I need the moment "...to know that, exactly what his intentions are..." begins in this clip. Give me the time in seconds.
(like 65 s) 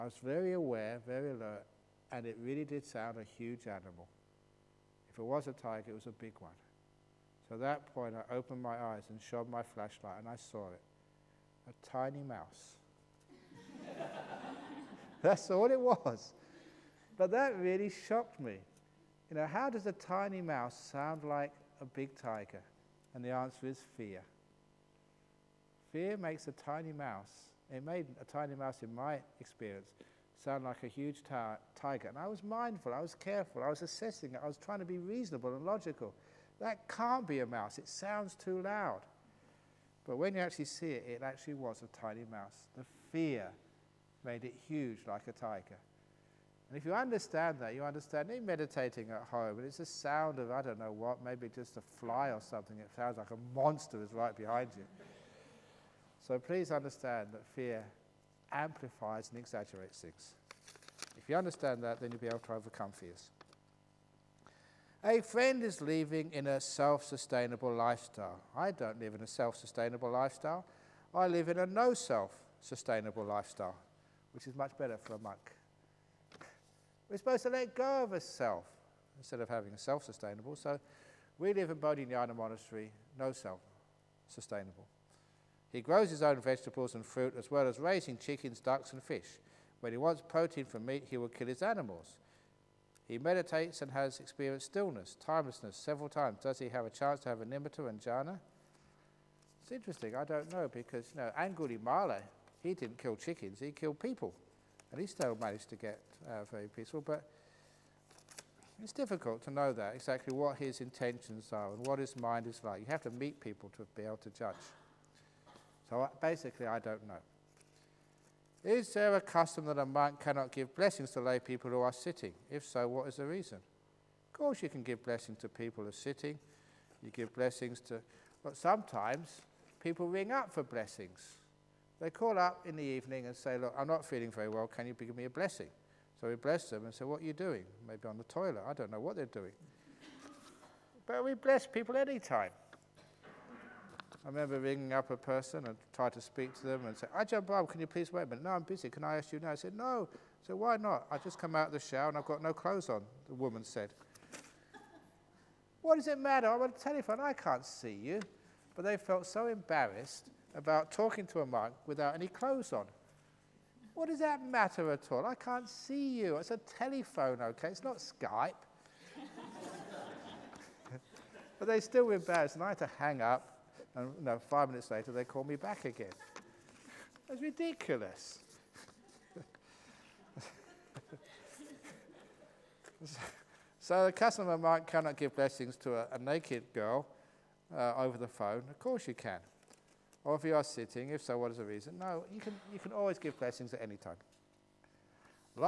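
109 s.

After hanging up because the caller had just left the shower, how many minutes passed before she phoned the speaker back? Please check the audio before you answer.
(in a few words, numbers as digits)
5 minutes.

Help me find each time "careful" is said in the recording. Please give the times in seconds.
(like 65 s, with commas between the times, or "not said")
33 s.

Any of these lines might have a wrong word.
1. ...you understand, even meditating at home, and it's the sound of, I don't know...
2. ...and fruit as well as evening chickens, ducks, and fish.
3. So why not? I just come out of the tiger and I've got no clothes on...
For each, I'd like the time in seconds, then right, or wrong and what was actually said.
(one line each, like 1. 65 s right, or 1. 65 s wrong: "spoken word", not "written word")
1. 47 s right
2. 86 s wrong: "raising", not "evening"
3. 150 s wrong: "shower", not "tiger".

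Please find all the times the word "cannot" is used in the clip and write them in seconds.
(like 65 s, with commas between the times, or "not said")
120 s, 184 s.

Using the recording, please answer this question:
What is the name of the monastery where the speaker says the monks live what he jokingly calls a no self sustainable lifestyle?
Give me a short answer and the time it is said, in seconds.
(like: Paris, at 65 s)
Bodhinyana Monastery, at 81 s.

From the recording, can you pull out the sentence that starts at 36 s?
That can't be a mouse, it sounds too loud.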